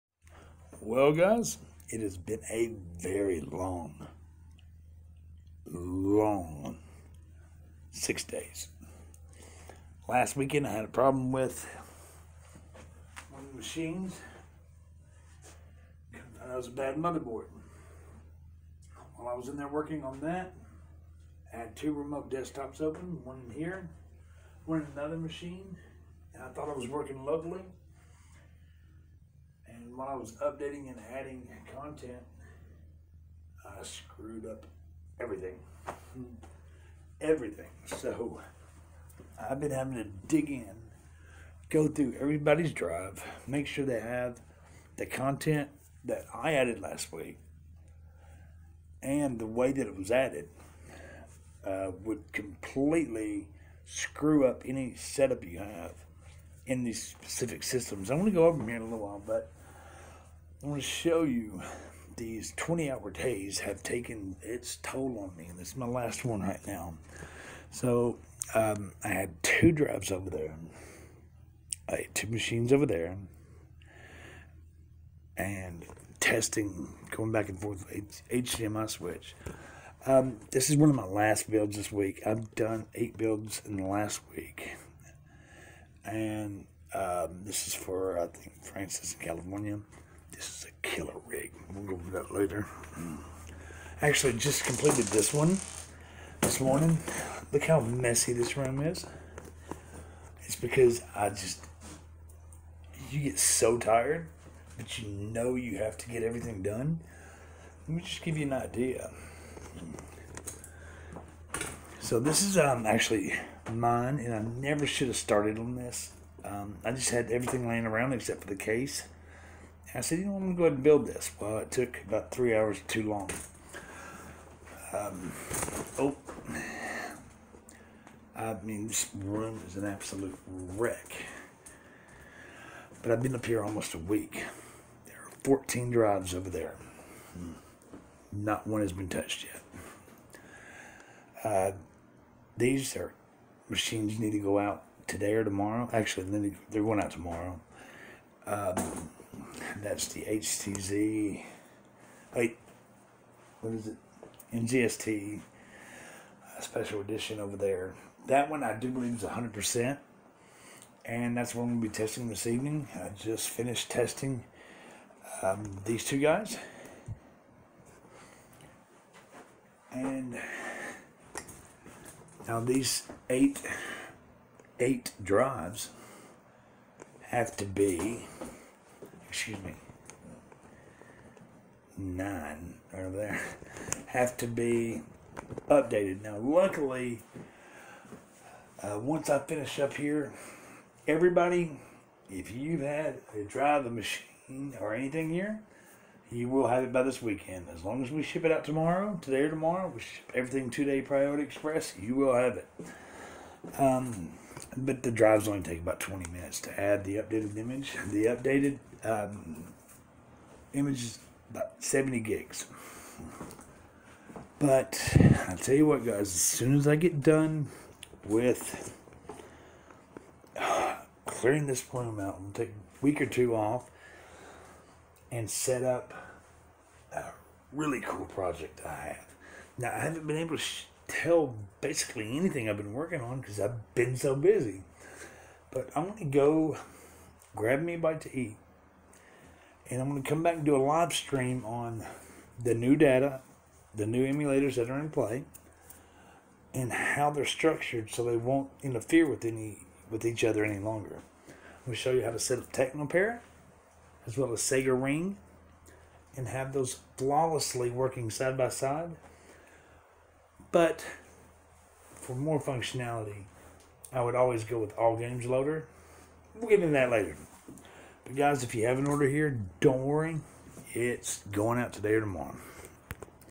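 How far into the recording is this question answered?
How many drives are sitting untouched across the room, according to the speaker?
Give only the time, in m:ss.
2:15.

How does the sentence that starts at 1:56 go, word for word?
Um, I just had everything laying around except for the case.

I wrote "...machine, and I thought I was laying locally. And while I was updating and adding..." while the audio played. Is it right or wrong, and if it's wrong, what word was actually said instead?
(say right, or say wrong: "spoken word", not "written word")
wrong: "working", not "laying".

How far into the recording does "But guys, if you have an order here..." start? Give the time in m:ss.
4:28.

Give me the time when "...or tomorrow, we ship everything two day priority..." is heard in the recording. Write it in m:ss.
3:19.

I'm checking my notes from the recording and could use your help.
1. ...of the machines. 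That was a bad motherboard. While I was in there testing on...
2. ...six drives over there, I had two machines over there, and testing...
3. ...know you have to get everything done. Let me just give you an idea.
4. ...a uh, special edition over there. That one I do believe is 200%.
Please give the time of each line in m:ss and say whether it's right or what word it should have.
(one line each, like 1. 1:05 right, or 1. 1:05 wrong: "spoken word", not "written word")
1. 0:13 wrong: "working", not "testing"
2. 1:09 wrong: "two", not "six"
3. 1:45 right
4. 2:35 wrong: "100", not "200".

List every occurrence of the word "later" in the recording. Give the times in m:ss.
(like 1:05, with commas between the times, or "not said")
1:32, 4:27.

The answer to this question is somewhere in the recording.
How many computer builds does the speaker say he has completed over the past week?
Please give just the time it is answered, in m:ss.
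1:22.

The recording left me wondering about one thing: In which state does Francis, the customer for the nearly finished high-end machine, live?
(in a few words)
California.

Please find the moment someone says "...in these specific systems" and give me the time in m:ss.
0:56.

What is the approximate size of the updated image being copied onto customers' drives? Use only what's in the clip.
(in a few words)
70 gigs.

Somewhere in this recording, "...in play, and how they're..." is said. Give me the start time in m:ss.
4:04.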